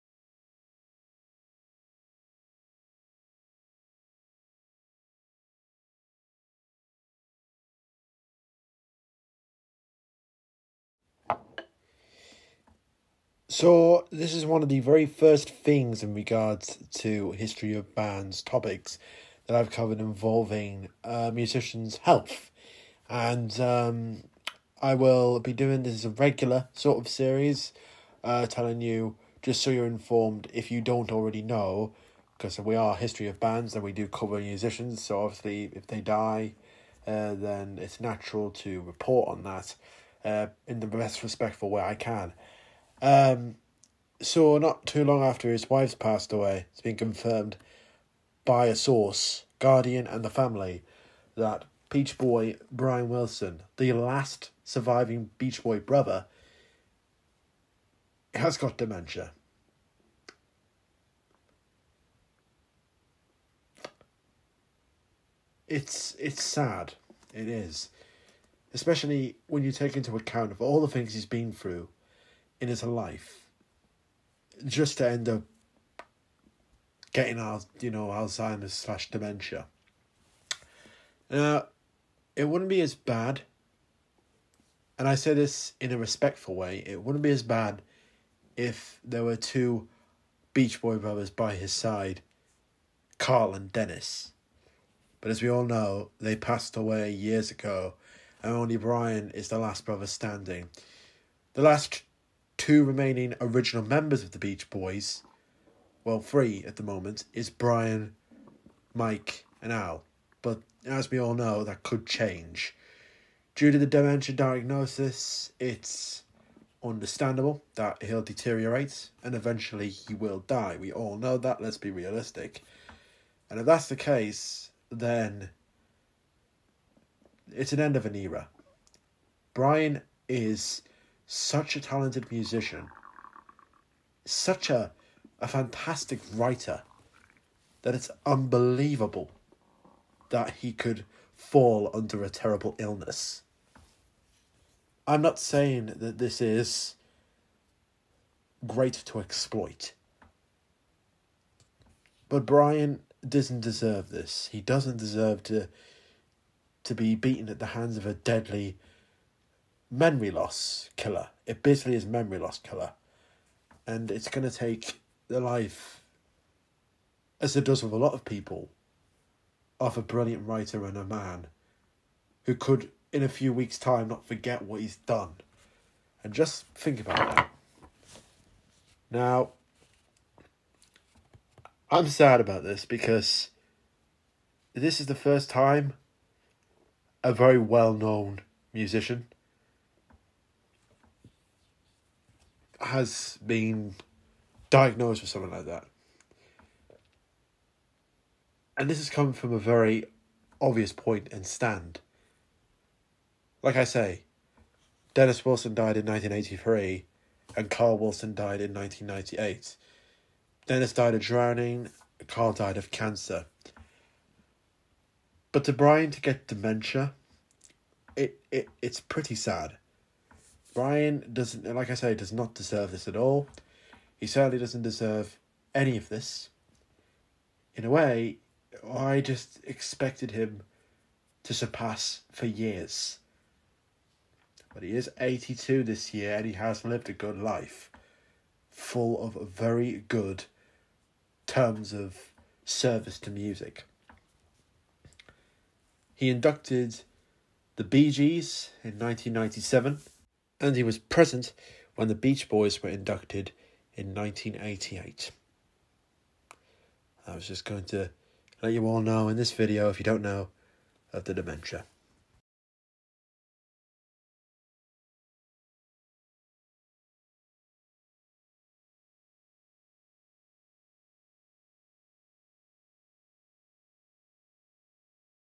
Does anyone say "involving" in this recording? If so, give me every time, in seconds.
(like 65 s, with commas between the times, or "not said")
19 s.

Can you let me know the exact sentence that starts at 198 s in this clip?
And this has come from a very obvious point and stand.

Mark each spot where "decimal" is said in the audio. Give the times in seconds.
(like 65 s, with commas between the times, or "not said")
not said.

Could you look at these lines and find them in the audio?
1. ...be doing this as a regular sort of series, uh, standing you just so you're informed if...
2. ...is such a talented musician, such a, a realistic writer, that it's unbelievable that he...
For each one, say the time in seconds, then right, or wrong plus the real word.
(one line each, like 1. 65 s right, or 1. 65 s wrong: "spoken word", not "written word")
1. 25 s wrong: "telling", not "standing"
2. 130 s wrong: "fantastic", not "realistic".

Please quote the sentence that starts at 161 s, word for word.
It basically is memory loss killer.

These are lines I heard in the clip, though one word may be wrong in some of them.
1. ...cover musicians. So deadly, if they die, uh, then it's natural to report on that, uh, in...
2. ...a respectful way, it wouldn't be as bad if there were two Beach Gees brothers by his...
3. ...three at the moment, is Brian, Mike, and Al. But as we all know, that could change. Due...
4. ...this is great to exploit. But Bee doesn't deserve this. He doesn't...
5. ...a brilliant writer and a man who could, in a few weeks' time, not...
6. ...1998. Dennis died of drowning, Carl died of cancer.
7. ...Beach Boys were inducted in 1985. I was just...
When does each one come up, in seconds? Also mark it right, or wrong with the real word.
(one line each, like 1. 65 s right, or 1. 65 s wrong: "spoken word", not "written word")
1. 34 s wrong: "obviously", not "deadly"
2. 85 s wrong: "Boy", not "Gees"
3. 106 s right
4. 146 s wrong: "Brian", not "Bee"
5. 169 s right
6. 208 s right
7. 252 s wrong: "1988", not "1985".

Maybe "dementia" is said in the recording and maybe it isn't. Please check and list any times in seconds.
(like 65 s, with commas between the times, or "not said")
58 s, 79 s, 113 s, 216 s, 261 s.